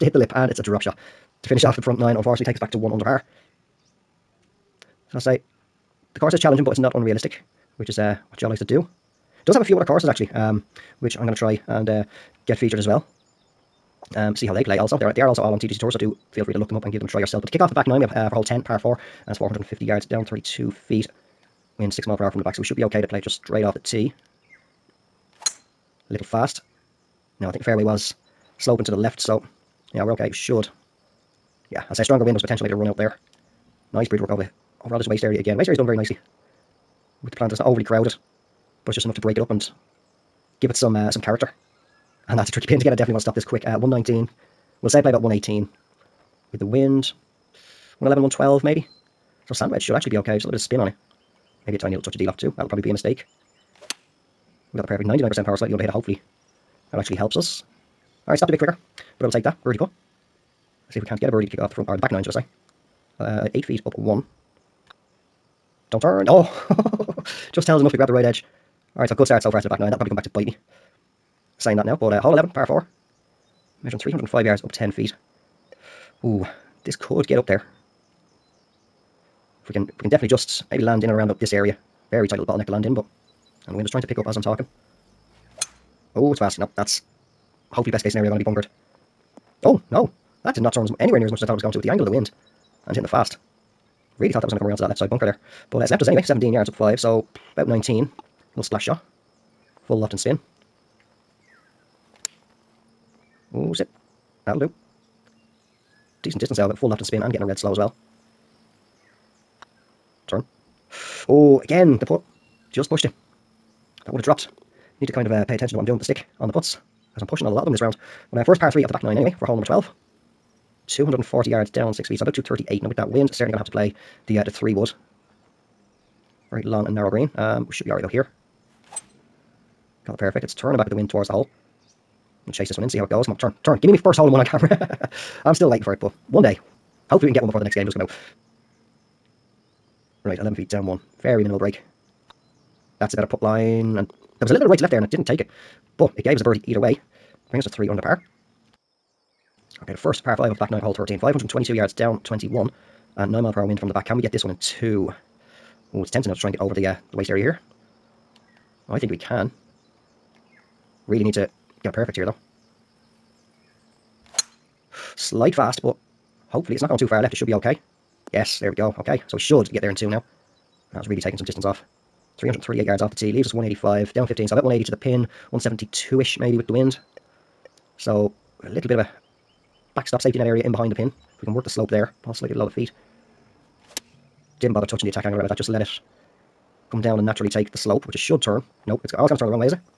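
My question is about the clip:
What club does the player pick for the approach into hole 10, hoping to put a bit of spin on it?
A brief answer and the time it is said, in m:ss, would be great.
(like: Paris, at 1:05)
sand wedge, at 0:49.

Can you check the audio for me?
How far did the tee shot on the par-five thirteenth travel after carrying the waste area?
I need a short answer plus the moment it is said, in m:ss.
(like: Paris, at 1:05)
338 yards, at 2:52.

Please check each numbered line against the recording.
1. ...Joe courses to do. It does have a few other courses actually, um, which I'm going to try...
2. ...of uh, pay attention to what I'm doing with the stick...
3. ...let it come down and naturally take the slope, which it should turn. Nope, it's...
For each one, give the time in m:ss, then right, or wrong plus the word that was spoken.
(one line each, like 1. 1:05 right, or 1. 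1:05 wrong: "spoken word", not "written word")
1. 0:08 wrong: "likes", not "courses"
2. 1:55 right
3. 3:05 right.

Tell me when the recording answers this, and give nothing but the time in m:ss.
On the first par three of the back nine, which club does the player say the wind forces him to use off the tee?
2:04.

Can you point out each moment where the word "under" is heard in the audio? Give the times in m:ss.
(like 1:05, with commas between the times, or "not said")
0:02, 0:55, 2:27.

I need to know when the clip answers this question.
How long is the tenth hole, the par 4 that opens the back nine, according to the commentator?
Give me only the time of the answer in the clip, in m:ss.
0:19.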